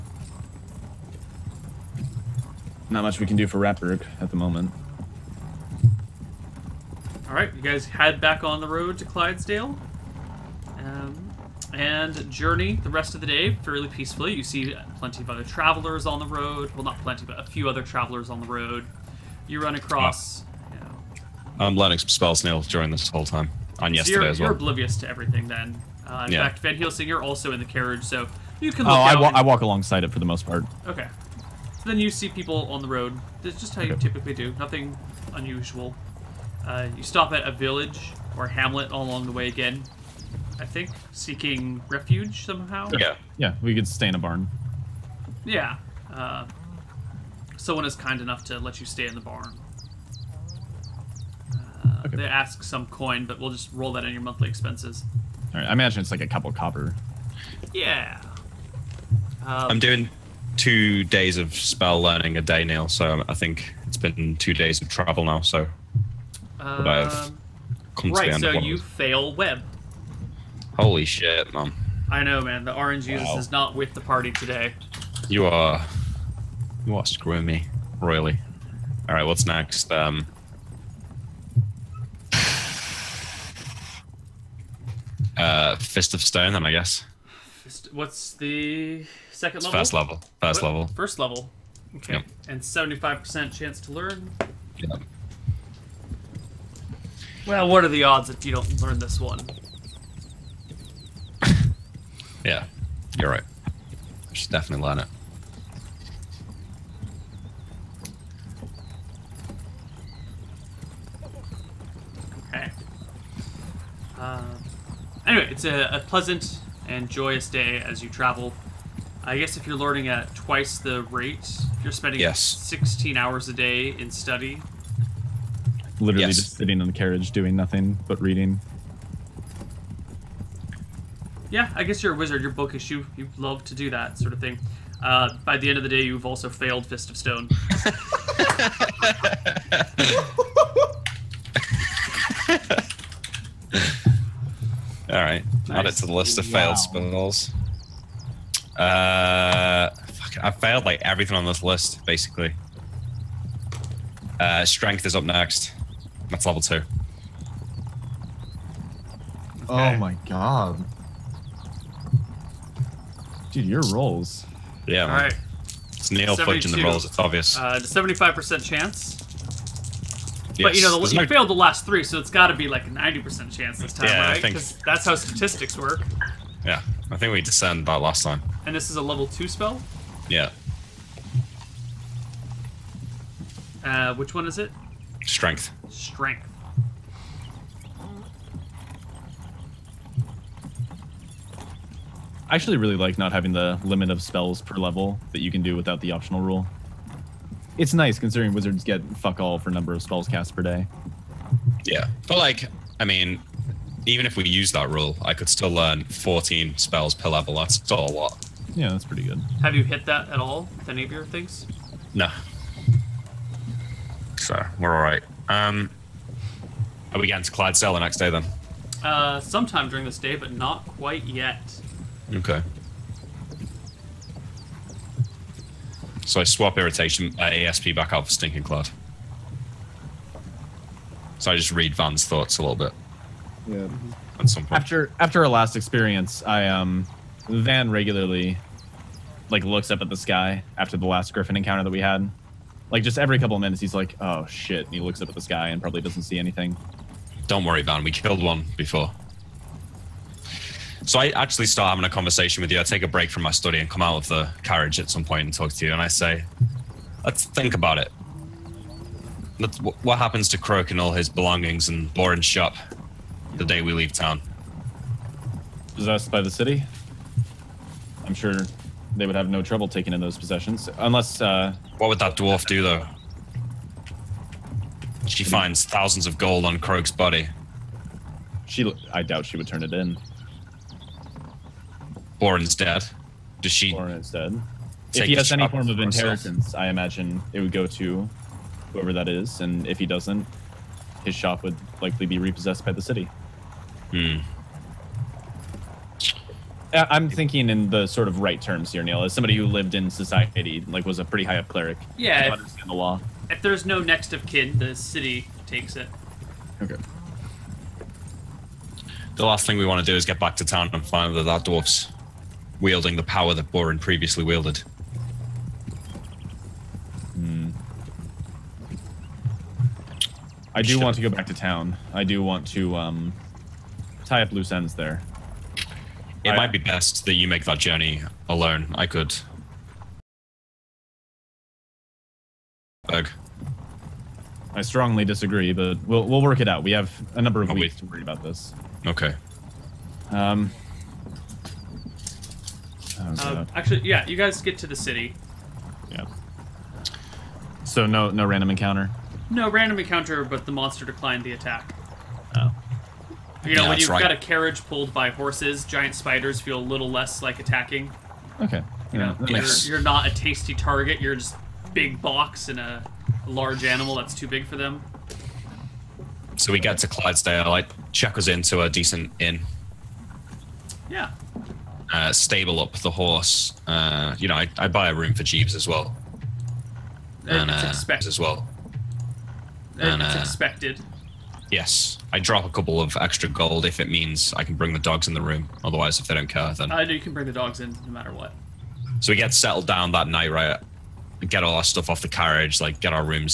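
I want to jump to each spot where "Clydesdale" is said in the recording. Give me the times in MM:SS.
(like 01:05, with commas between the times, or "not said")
00:09, 03:37, 06:07.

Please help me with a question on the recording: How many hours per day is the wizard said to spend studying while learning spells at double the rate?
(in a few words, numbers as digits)
16.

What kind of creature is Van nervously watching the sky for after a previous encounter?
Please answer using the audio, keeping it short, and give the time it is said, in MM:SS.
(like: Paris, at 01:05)
Griffin, at 04:01.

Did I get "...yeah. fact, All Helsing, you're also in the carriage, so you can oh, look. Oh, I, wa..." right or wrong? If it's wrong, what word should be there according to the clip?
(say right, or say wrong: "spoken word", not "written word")
wrong: "Van", not "All".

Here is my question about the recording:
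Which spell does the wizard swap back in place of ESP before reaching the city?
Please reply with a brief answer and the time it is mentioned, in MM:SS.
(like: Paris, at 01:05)
Stinking Cloud, at 03:48.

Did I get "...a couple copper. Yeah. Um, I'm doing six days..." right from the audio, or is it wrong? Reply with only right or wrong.
wrong.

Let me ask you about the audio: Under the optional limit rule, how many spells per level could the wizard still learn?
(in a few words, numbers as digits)
14.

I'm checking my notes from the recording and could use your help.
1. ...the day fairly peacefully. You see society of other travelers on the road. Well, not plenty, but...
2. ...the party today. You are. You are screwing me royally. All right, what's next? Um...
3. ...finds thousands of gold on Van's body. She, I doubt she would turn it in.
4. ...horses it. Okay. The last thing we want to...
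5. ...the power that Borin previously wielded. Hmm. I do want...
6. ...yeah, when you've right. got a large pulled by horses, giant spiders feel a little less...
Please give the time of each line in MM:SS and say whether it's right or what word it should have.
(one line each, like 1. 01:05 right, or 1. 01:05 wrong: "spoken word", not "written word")
1. 00:13 wrong: "plenty", not "society"
2. 01:13 right
3. 04:35 wrong: "Croak", not "Van"
4. 05:05 wrong: "takes", not "horses"
5. 05:13 right
6. 05:53 wrong: "carriage", not "large".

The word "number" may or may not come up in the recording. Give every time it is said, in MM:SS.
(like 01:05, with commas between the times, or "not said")
03:19, 05:37.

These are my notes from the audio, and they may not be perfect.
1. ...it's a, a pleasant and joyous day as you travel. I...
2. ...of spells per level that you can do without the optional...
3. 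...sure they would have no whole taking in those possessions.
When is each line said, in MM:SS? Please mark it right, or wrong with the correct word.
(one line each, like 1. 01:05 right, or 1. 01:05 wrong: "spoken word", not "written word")
1. 01:55 right
2. 03:14 right
3. 04:28 wrong: "trouble", not "whole".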